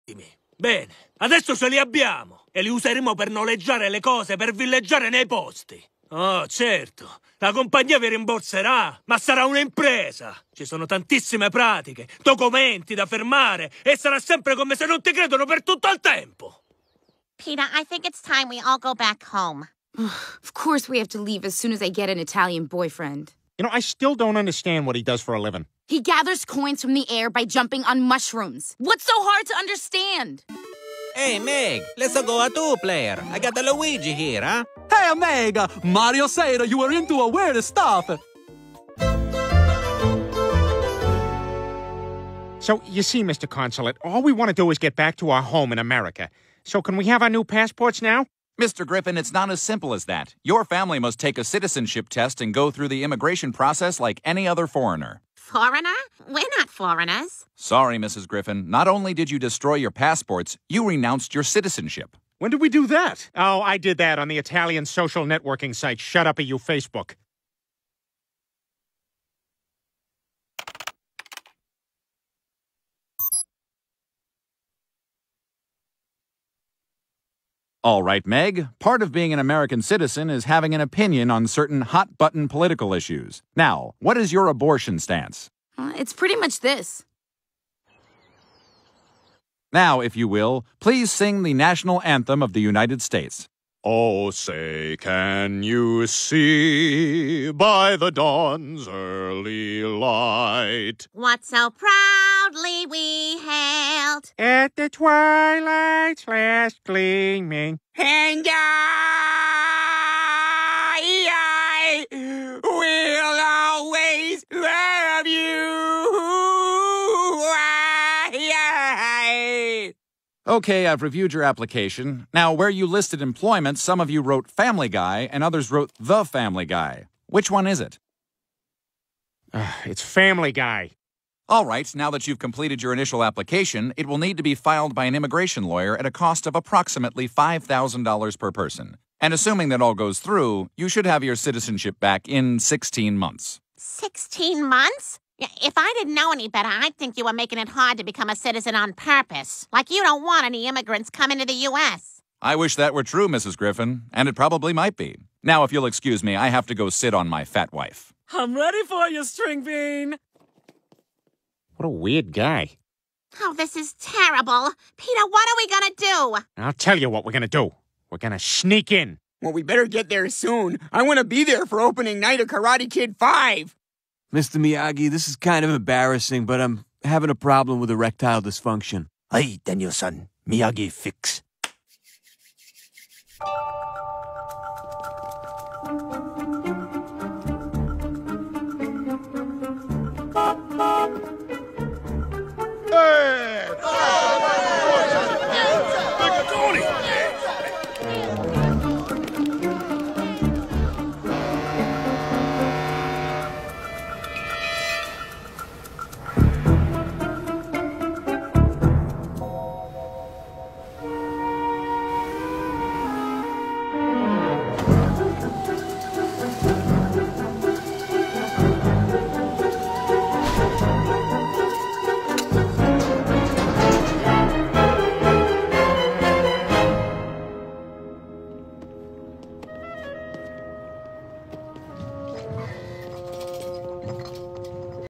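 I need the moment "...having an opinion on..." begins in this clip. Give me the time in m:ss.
1:20.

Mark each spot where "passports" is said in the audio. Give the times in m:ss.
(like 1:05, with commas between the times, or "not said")
0:47, 0:59.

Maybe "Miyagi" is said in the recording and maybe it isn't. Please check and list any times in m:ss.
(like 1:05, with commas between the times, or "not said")
2:54, 3:00.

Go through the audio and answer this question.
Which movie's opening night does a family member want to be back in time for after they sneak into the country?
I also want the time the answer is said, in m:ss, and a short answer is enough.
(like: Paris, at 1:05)
Karate Kid 5, at 2:52.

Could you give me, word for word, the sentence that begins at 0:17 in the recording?
Pina, I think it's time we all go back home.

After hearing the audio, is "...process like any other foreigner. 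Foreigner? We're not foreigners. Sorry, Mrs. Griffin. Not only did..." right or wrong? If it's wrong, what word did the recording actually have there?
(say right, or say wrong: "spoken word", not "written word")
right.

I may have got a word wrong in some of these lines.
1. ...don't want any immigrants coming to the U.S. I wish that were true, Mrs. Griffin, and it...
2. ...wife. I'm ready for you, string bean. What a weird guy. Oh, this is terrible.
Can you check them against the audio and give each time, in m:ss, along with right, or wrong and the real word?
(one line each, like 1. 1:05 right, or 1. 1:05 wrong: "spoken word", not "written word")
1. 2:30 right
2. 2:37 right.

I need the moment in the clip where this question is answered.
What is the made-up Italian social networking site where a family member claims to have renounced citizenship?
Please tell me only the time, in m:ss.
1:05.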